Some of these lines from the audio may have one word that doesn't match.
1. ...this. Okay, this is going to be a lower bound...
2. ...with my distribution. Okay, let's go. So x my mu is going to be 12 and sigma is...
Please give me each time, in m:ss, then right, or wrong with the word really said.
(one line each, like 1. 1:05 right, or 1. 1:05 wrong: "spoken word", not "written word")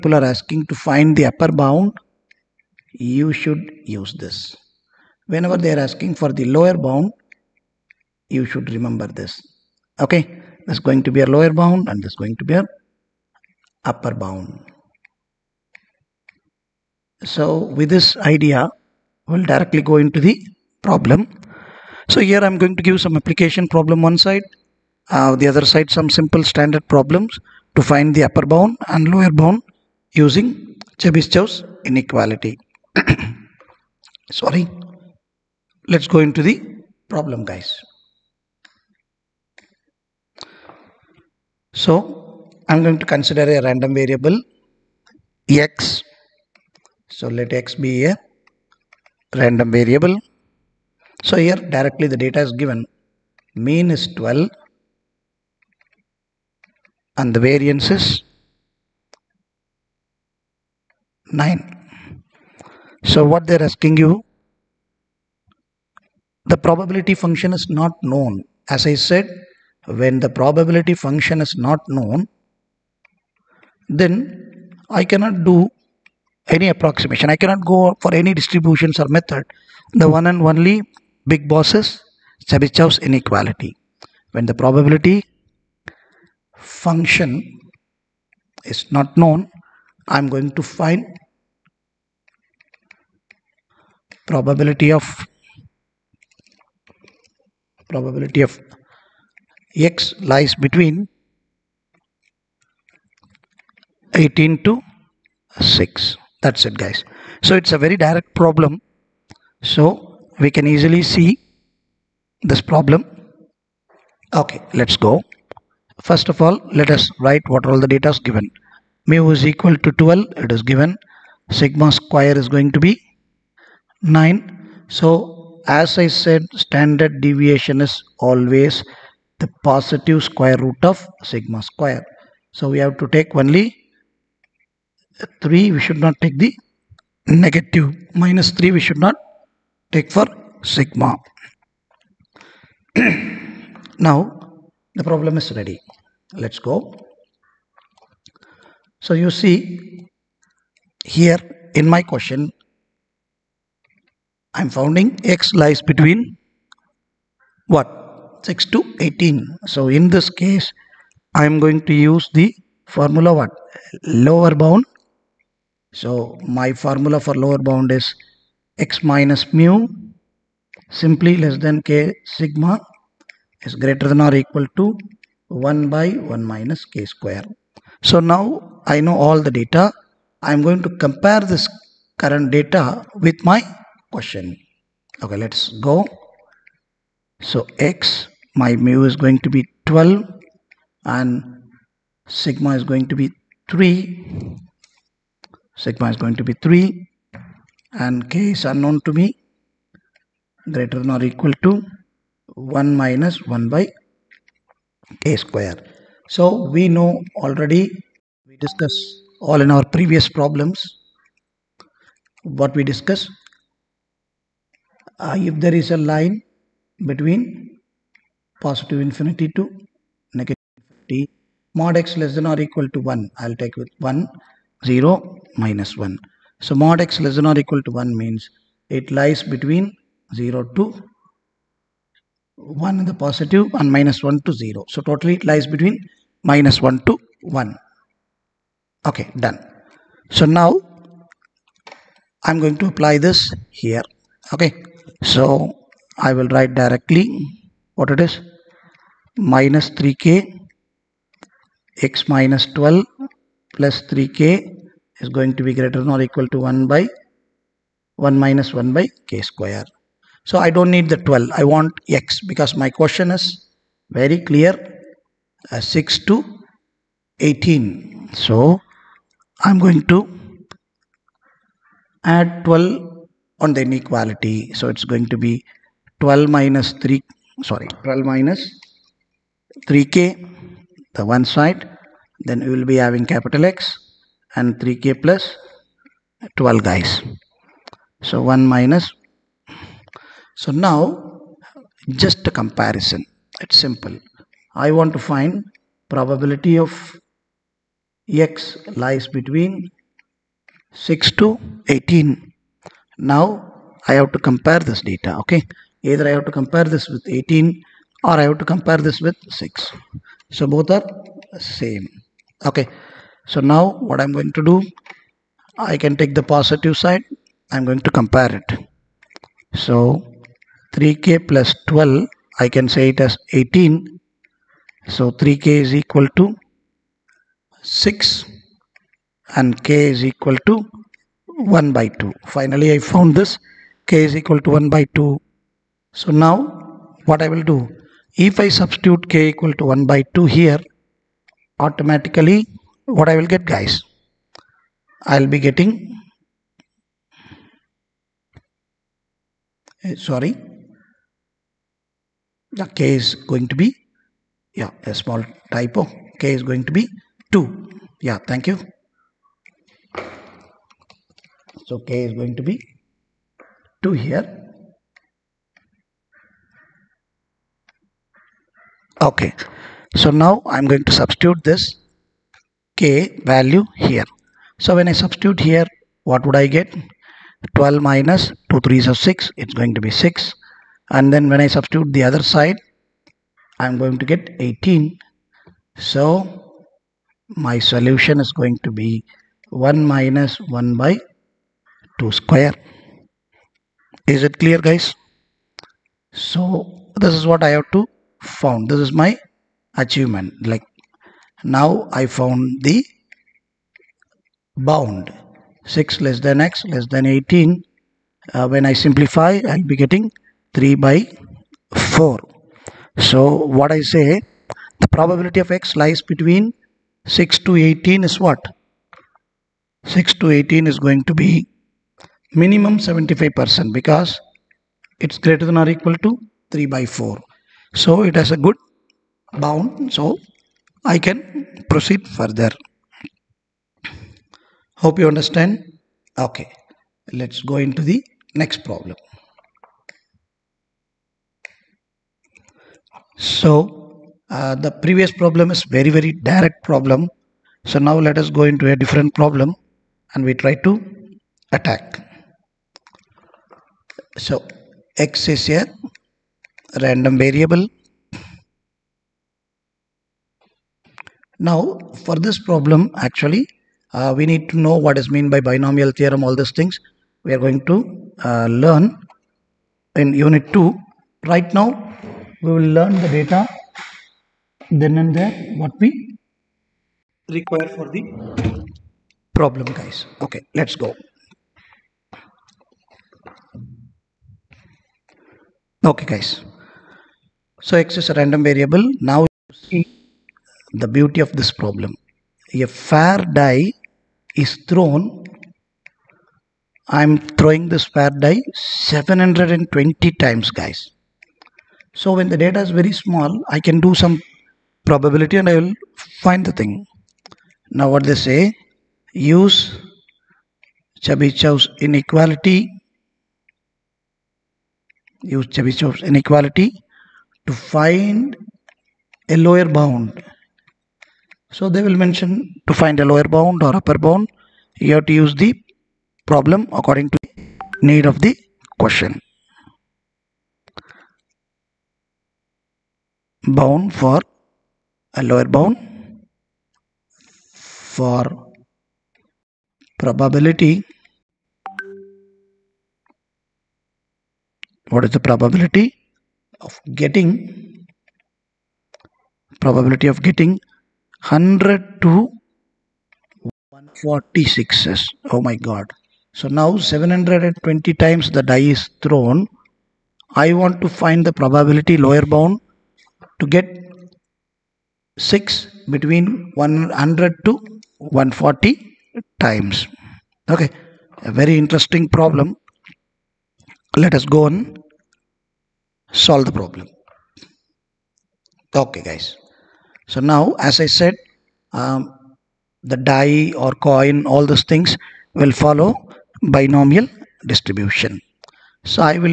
1. 0:09 right
2. 3:03 wrong: "question", not "distribution".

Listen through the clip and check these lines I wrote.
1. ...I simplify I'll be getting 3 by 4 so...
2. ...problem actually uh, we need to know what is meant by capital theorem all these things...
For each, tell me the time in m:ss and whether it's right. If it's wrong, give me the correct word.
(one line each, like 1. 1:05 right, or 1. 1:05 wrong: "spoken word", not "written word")
1. 6:48 right
2. 7:42 wrong: "binomial", not "capital".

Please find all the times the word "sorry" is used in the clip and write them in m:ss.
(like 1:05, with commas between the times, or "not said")
0:34, 4:37, 5:50.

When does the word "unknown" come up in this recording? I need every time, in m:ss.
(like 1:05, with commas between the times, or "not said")
3:18.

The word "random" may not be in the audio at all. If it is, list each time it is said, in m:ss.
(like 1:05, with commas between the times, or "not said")
0:43, 0:49, 7:37, 8:08.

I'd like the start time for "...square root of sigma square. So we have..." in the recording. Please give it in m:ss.
2:10.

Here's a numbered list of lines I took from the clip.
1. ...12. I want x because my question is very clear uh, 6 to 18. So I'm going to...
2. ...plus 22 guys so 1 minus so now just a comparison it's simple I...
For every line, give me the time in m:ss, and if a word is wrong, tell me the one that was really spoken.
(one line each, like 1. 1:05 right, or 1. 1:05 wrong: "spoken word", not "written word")
1. 4:21 right
2. 4:45 wrong: "12", not "22".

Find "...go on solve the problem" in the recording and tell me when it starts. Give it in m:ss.
9:34.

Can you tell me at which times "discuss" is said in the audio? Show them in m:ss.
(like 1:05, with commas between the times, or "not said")
3:28, 3:32.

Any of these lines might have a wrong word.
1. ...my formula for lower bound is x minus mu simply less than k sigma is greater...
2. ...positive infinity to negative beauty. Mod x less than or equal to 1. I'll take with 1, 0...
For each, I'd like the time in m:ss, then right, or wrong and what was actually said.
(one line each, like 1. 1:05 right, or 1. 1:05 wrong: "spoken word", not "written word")
1. 2:46 right
2. 3:38 wrong: "infinity", not "beauty".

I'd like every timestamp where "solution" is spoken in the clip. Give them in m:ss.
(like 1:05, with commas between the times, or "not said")
6:27.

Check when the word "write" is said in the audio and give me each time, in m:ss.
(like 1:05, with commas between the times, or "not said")
1:57, 4:06.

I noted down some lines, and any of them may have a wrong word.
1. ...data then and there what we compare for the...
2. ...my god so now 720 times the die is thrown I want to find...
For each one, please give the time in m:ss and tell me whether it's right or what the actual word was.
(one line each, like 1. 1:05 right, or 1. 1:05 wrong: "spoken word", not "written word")
1. 7:53 wrong: "require", not "compare"
2. 9:15 right.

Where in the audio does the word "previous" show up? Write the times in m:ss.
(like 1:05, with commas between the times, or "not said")
3:29, 7:24.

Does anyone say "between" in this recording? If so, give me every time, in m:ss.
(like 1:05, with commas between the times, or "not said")
1:40, 2:35, 3:37, 3:49, 3:55, 4:59, 6:56, 9:26.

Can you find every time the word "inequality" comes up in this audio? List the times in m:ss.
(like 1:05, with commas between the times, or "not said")
0:31, 1:22, 4:33, 8:31, 8:36.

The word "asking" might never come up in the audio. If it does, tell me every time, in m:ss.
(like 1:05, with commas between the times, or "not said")
0:00, 0:05, 1:03.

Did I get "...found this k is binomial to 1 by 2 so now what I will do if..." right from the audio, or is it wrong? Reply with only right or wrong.
wrong.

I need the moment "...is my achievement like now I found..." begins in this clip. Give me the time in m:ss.
6:38.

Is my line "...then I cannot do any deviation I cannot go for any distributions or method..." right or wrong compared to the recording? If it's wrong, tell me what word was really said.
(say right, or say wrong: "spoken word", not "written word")
wrong: "approximation", not "deviation".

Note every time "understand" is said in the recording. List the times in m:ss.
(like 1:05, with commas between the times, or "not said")
7:15.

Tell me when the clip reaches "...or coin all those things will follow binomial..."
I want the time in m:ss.
9:43.